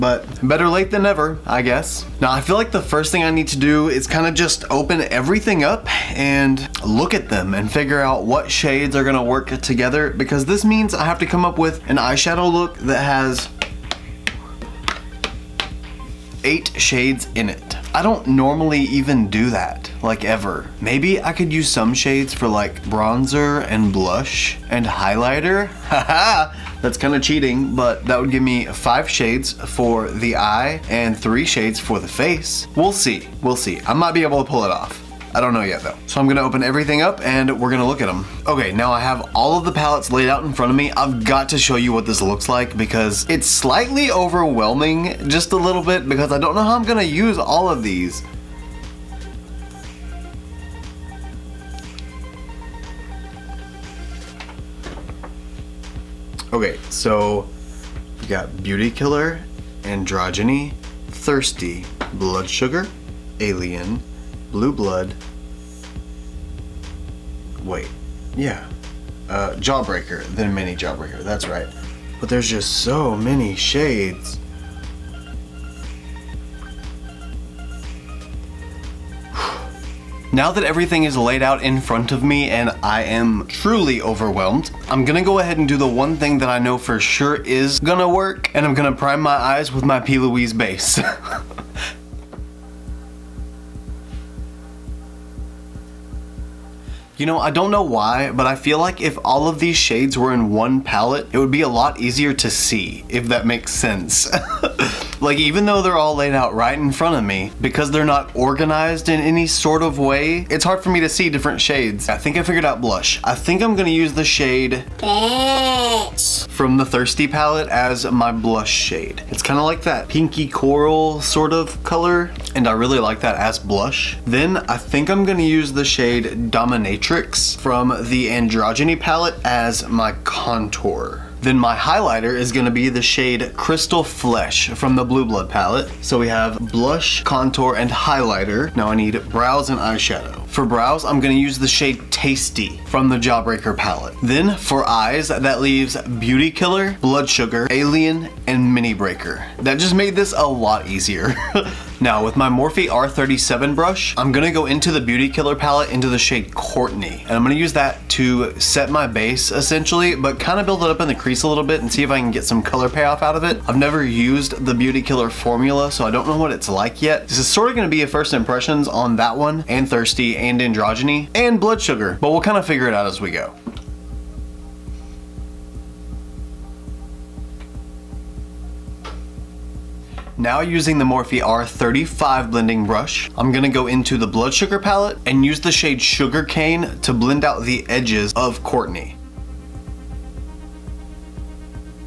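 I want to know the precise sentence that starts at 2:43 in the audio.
I've never used the Beauty Killer formula, so I don't know what it's like yet.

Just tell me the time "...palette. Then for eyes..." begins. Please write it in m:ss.
2:23.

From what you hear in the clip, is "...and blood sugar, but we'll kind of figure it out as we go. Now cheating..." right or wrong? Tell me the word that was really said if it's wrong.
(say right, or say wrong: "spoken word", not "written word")
wrong: "using", not "cheating".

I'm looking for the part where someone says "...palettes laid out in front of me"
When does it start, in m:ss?
0:39.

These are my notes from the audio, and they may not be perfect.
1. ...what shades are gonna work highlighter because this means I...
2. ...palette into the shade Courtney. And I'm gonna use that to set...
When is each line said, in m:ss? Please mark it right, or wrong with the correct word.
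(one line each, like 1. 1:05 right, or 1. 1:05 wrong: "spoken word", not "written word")
1. 0:08 wrong: "together", not "highlighter"
2. 2:35 right.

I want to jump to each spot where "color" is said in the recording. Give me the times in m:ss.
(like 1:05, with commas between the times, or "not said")
2:01, 2:42.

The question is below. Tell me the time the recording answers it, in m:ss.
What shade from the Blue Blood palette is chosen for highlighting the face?
2:13.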